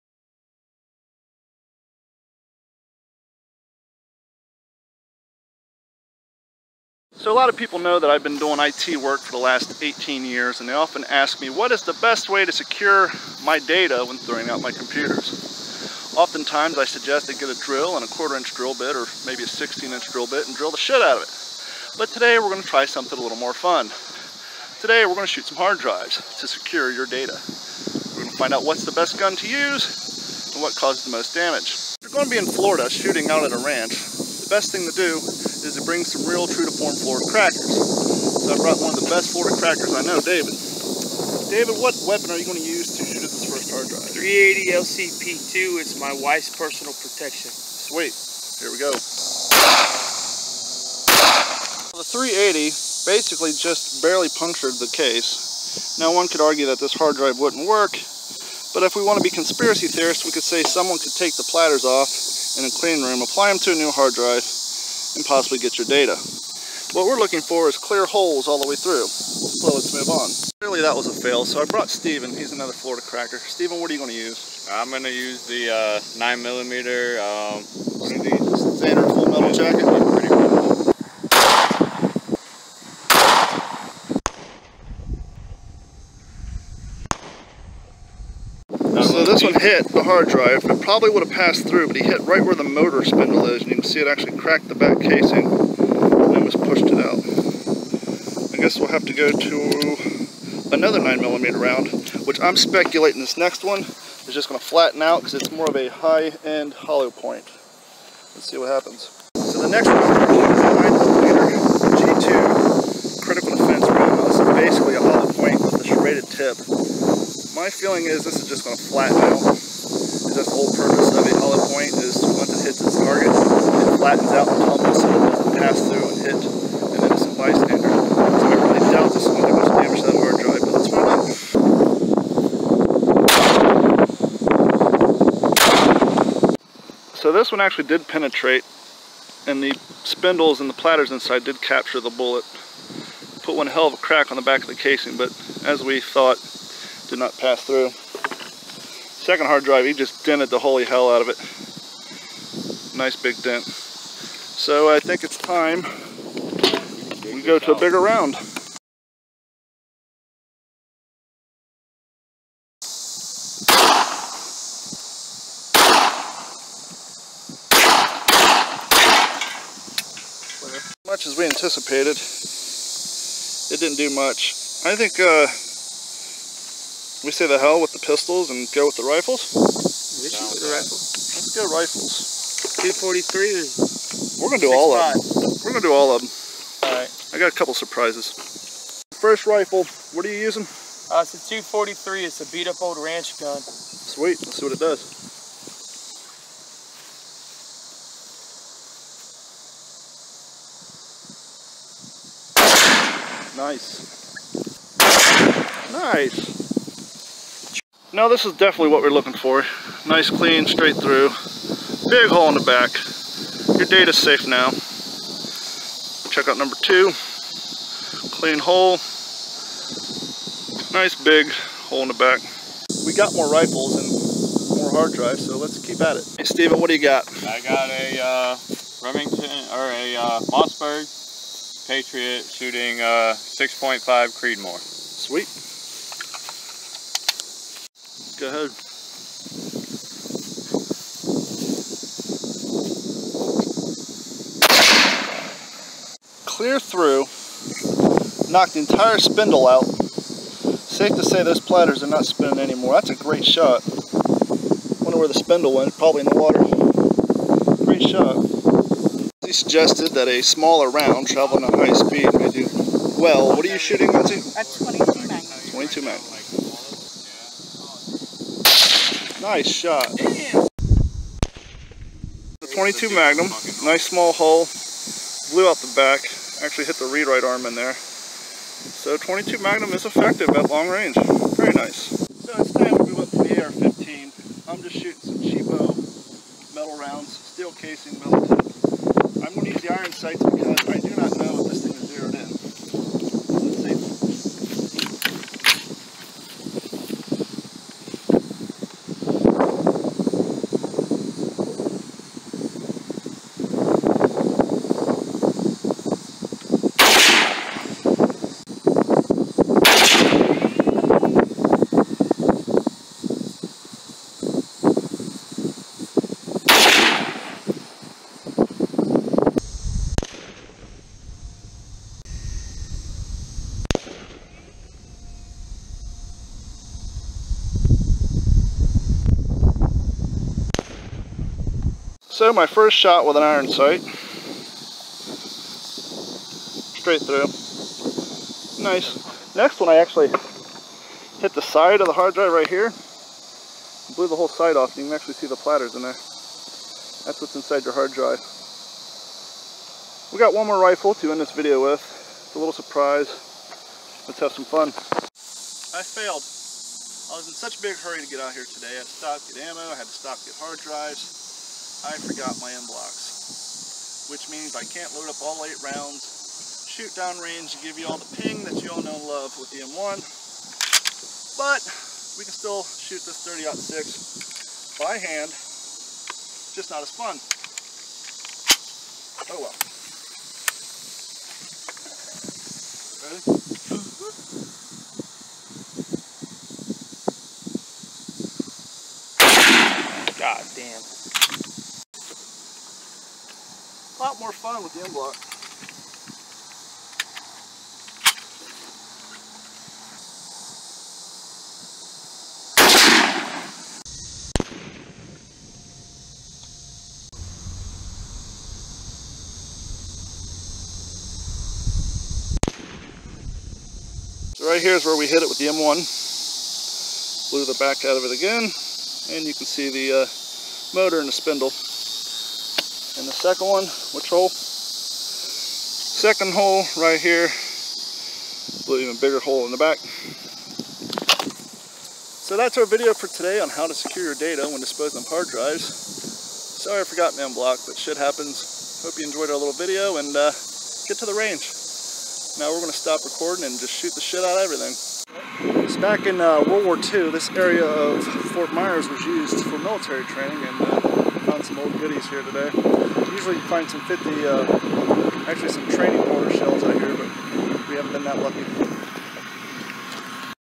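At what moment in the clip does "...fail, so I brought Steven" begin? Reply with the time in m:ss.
1:11.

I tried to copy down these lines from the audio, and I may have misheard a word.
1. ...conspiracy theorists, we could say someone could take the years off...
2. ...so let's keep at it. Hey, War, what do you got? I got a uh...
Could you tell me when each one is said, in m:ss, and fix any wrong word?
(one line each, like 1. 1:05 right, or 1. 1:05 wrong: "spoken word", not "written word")
1. 0:59 wrong: "platters", not "years"
2. 3:45 wrong: "Steven", not "War".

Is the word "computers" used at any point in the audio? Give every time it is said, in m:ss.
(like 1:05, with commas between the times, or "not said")
0:14.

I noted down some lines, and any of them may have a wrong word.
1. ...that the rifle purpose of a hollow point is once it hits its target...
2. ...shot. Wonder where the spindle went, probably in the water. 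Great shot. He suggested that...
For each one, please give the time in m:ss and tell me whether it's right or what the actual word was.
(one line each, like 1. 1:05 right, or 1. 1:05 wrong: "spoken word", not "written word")
1. 2:00 wrong: "whole", not "rifle"
2. 4:13 right.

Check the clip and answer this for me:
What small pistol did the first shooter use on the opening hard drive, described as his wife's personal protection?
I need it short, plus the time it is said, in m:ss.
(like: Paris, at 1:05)
380 LCP2, at 0:44.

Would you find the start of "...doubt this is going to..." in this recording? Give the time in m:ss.
2:08.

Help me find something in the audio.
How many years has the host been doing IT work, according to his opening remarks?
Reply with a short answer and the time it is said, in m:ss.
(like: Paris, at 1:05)
18, at 0:09.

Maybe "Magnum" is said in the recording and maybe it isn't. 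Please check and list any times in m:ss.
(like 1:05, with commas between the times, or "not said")
4:33, 4:39.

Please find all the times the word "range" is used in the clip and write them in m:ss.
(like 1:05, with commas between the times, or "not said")
4:40, 6:07, 7:21.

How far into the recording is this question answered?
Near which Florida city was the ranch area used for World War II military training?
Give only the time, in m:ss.
7:28.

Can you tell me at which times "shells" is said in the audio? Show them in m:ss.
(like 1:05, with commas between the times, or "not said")
7:36.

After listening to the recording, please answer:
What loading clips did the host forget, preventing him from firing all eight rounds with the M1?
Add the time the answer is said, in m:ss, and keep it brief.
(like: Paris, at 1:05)
en blocs, at 6:02.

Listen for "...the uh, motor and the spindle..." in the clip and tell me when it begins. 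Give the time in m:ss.
6:59.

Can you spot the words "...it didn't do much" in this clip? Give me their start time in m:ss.
2:53.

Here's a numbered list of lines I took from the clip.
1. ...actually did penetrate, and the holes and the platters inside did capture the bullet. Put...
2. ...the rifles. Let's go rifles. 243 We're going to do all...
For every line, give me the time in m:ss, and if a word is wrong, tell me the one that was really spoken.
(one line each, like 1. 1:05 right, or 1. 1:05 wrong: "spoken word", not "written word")
1. 2:17 wrong: "spindles", not "holes"
2. 3:00 right.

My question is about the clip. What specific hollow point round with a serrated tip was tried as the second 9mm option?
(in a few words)
G2 critical defense.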